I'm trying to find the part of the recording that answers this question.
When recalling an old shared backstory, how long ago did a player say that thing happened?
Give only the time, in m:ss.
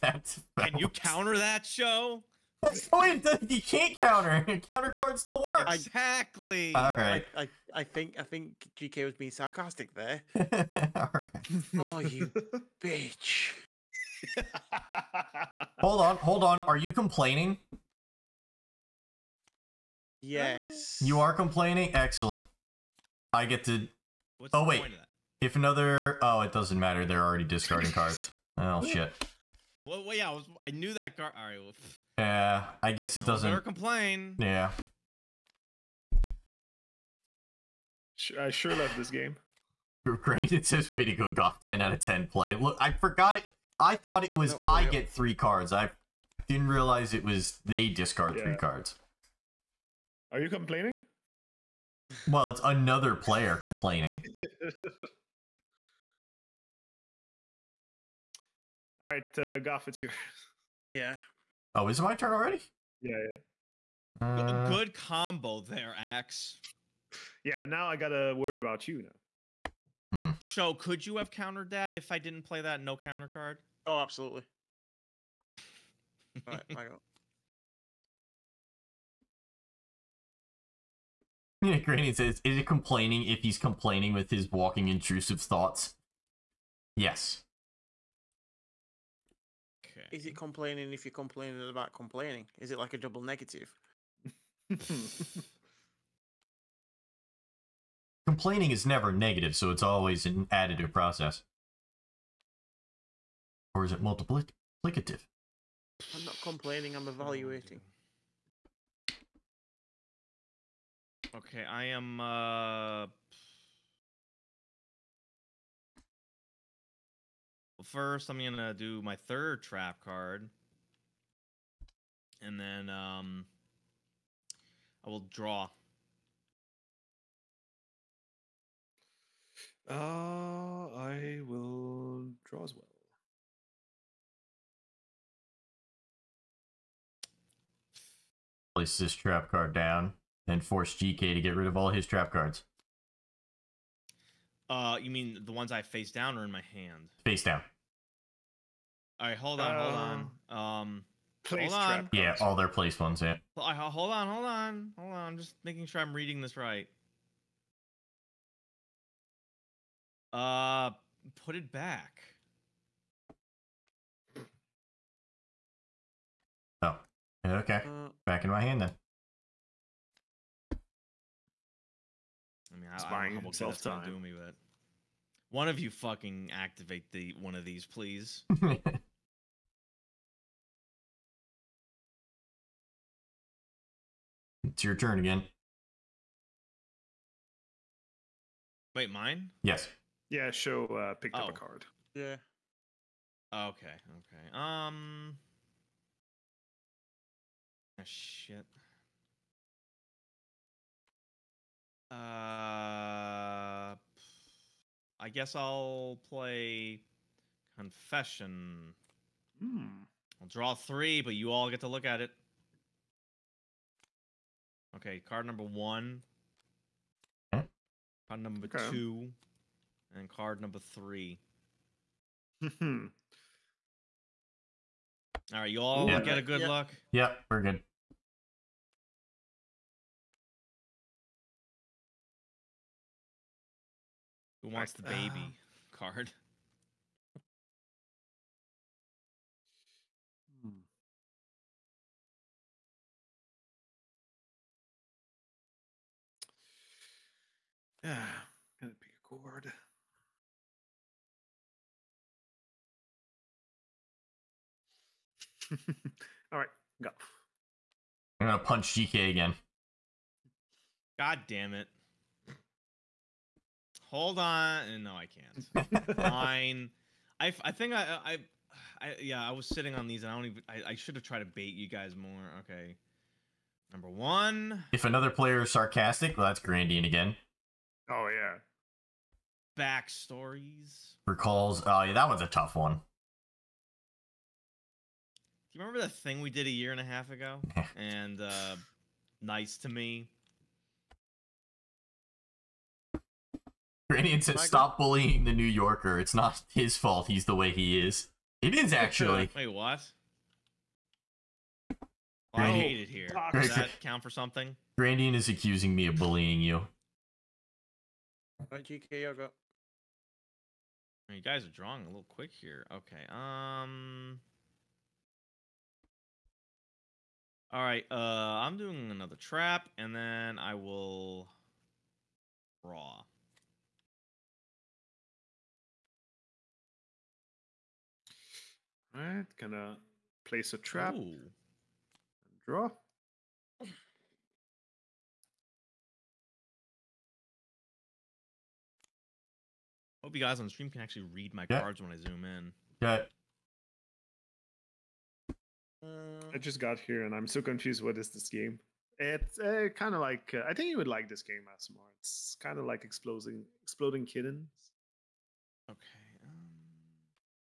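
4:46.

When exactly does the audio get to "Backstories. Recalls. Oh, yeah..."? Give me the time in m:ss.
4:39.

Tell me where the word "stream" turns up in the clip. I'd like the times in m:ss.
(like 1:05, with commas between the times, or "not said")
5:40.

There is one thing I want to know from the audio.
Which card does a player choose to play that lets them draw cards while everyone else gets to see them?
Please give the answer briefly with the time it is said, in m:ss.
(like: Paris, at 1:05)
Confession, at 3:27.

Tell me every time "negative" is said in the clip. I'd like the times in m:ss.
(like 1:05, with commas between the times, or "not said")
1:33, 1:39.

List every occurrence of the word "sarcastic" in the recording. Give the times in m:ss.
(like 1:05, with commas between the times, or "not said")
0:09, 4:35.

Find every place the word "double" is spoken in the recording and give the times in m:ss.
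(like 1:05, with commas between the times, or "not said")
1:32.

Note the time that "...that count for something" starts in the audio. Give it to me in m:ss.
5:03.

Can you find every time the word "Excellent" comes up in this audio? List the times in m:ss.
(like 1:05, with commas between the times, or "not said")
0:21.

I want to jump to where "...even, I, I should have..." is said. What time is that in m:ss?
4:30.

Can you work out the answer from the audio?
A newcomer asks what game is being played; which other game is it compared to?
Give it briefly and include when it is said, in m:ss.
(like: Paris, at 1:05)
Exploding Kittens, at 5:53.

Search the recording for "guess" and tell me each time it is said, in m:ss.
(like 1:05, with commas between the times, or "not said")
0:32, 3:25.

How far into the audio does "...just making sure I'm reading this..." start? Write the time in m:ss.
2:35.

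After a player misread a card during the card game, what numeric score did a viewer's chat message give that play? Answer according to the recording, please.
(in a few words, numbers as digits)
10 out of 10.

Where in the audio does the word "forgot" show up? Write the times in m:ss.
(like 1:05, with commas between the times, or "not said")
0:42.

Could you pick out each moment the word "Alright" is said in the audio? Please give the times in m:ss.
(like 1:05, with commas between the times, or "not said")
5:29.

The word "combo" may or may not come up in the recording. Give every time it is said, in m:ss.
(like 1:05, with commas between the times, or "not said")
1:04.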